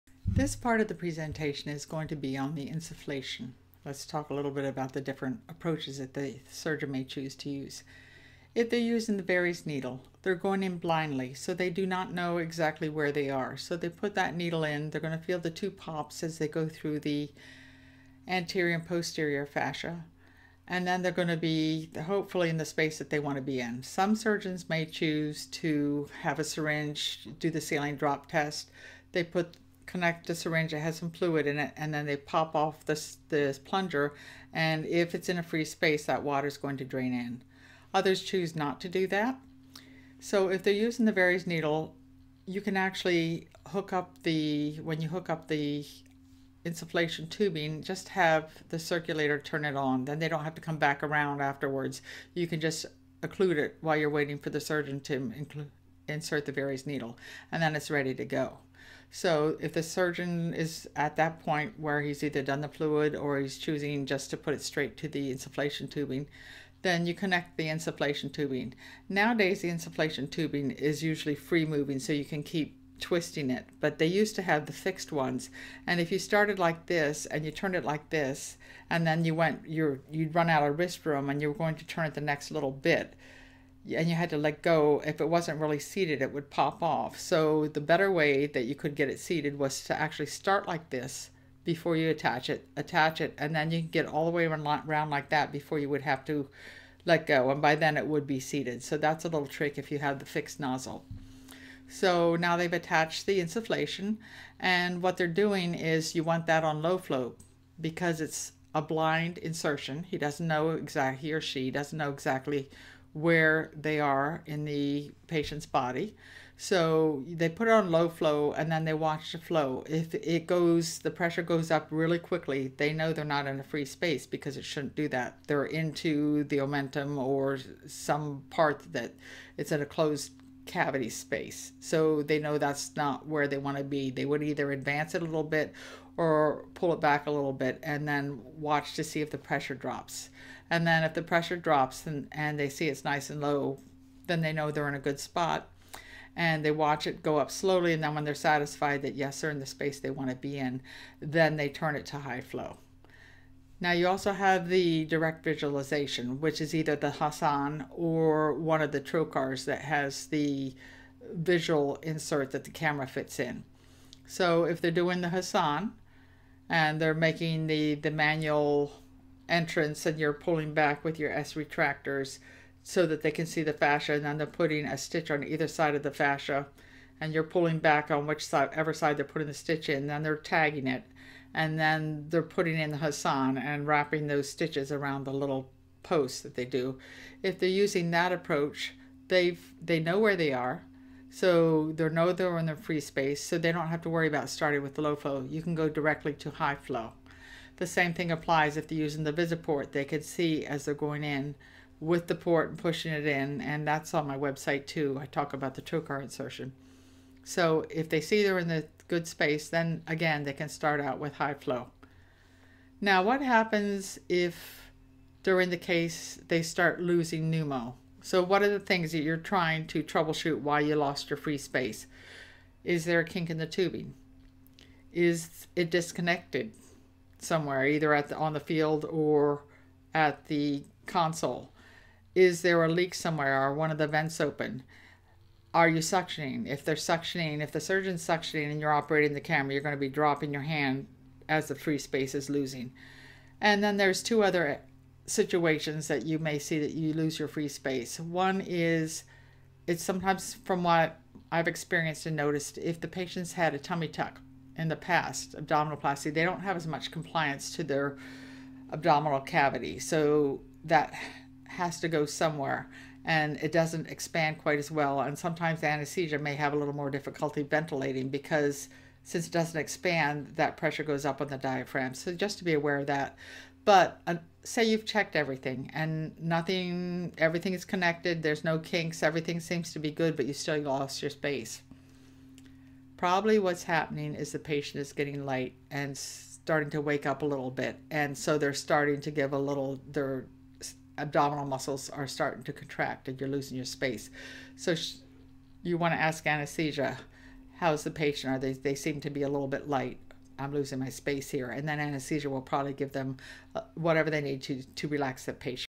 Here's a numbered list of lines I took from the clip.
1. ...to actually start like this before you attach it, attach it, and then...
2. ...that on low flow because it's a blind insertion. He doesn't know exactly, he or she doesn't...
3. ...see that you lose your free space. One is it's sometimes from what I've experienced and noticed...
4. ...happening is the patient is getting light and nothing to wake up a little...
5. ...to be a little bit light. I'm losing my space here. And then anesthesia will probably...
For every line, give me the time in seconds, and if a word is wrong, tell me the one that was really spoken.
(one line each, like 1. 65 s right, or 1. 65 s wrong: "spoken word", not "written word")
1. 89 s right
2. 106 s right
3. 246 s right
4. 283 s wrong: "starting", not "nothing"
5. 299 s right.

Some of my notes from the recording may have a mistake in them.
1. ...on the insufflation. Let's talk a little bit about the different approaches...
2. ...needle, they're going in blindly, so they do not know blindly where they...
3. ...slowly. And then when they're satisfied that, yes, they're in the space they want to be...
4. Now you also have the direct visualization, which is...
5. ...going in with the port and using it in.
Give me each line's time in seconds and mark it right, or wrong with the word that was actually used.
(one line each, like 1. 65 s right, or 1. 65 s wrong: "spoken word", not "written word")
1. 2 s right
2. 9 s wrong: "exactly", not "blindly"
3. 147 s right
4. 153 s right
5. 200 s wrong: "pushing", not "using".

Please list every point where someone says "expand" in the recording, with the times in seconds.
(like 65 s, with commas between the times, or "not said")
264 s, 269 s.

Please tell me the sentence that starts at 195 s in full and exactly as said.
You can go directly to high flow.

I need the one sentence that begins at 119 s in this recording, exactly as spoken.
If it goes, the pressure goes up really quickly, they know they're not in a free space because it shouldn't do that.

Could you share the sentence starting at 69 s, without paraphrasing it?
Nowadays, the insufflation tubing is usually free moving, so you can keep twisting it, but they used to have the fixed ones.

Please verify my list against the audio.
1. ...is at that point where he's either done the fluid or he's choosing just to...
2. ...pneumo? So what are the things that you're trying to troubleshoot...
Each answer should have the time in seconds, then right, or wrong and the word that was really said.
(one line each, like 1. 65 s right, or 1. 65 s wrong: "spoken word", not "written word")
1. 60 s right
2. 217 s right.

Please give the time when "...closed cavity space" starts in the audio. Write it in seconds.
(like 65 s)
129 s.